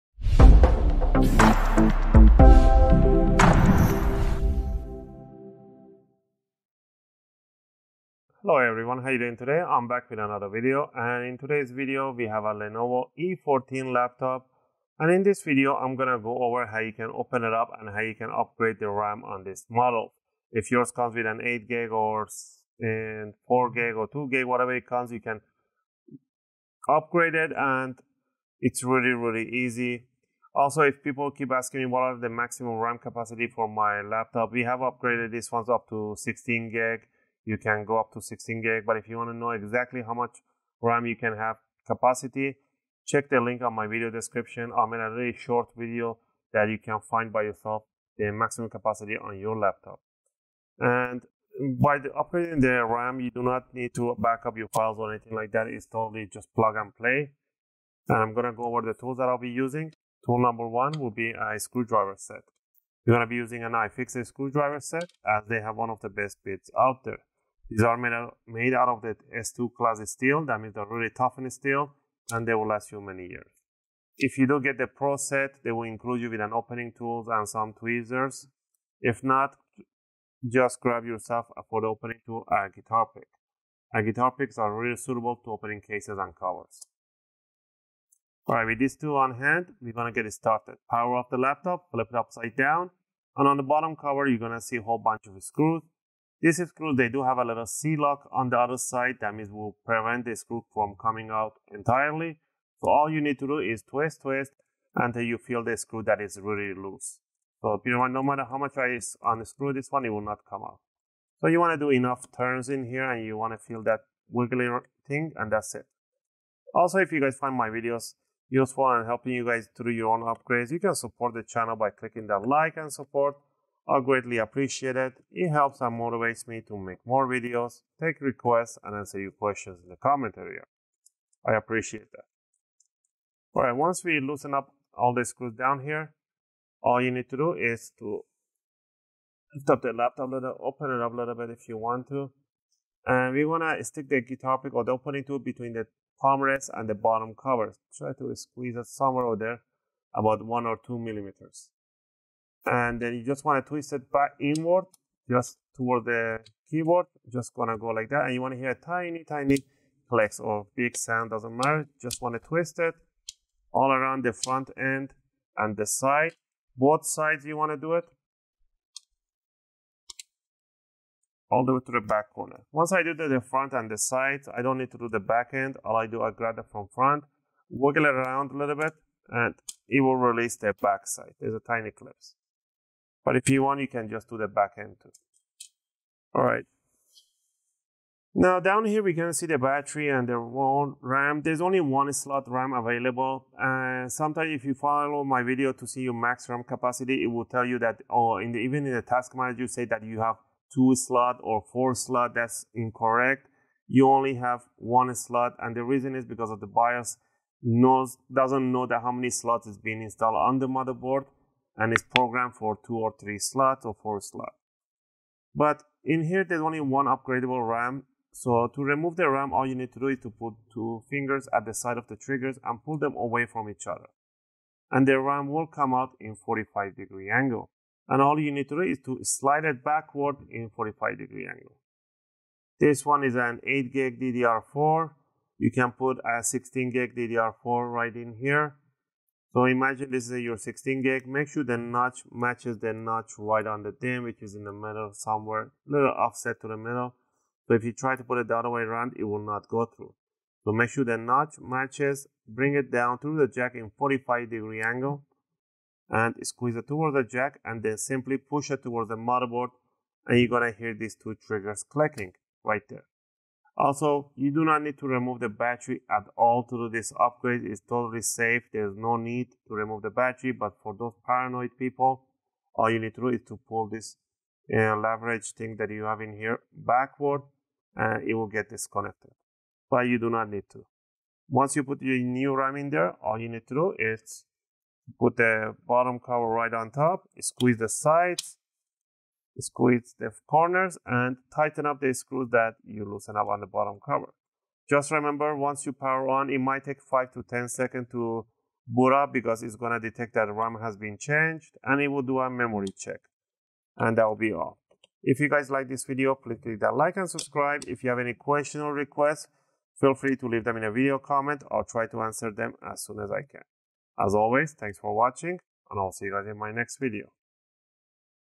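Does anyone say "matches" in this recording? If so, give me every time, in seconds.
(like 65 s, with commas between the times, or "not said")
242 s, 251 s.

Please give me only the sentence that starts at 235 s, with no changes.
You can put a 16 gig DDR4 right in here so imagine this is your 16 gig.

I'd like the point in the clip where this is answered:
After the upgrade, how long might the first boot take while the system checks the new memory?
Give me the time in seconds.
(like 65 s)
297 s.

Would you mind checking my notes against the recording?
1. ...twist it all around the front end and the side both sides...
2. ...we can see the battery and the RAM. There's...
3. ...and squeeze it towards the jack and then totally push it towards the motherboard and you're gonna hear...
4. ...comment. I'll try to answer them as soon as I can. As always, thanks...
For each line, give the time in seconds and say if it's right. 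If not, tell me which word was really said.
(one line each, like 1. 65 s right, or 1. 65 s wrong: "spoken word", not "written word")
1. 162 s right
2. 189 s right
3. 256 s wrong: "simply", not "totally"
4. 311 s right.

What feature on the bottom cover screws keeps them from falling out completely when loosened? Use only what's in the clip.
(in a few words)
C-lock.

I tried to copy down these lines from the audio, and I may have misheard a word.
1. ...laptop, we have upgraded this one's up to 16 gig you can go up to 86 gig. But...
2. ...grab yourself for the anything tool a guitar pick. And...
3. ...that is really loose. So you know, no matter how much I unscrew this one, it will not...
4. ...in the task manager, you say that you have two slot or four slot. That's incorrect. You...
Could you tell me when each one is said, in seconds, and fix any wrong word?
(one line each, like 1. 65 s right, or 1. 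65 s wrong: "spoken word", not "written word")
1. 34 s wrong: "16", not "86"
2. 80 s wrong: "opening", not "anything"
3. 106 s right
4. 198 s right.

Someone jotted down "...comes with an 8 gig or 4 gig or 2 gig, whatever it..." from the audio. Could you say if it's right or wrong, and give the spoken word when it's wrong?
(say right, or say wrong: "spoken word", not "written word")
right.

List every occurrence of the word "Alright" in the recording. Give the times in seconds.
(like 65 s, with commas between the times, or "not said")
88 s, 133 s.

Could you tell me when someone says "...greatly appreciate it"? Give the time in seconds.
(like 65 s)
123 s.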